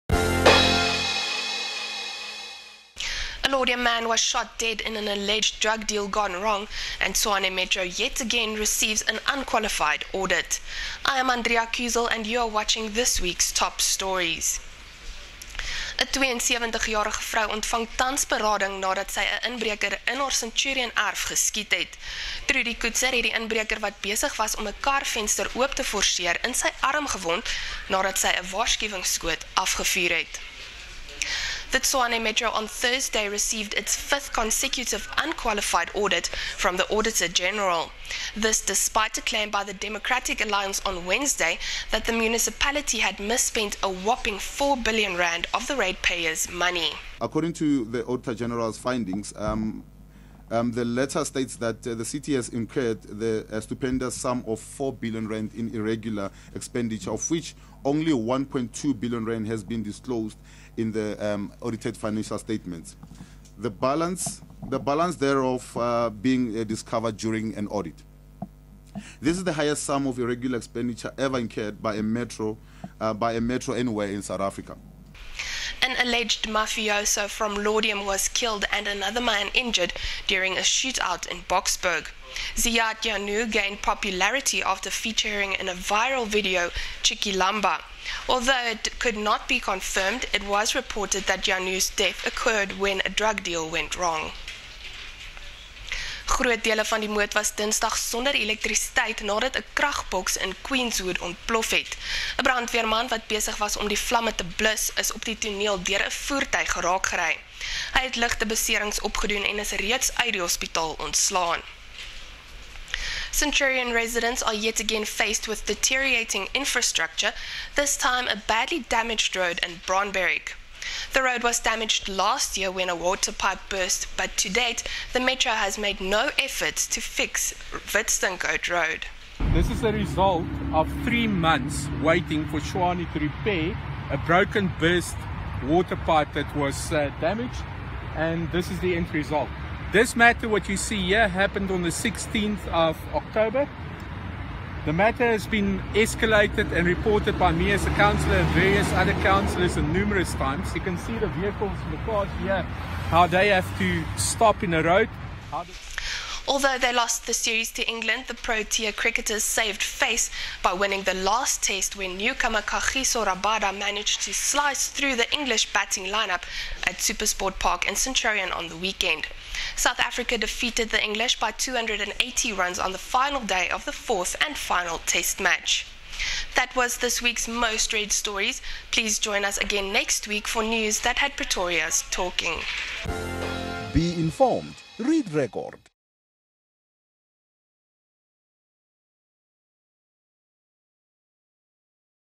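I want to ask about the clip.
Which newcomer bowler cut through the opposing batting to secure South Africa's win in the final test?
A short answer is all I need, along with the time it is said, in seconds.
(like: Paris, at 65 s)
Kagiso Rabada, at 162 s.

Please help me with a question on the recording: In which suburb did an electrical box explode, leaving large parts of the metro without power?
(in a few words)
Queenswood.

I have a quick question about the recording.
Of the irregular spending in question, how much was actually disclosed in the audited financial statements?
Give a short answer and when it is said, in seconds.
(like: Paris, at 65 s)
1.2 billion rand, at 58 s.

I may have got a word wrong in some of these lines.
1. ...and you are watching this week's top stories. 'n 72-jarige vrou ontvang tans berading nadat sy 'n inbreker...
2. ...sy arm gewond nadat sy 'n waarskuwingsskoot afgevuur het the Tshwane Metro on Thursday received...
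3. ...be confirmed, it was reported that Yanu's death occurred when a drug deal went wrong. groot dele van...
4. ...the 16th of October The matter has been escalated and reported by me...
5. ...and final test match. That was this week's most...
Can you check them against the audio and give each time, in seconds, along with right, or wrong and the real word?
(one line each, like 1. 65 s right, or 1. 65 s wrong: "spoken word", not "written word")
1. 12 s right
2. 26 s right
3. 89 s right
4. 141 s right
5. 174 s right.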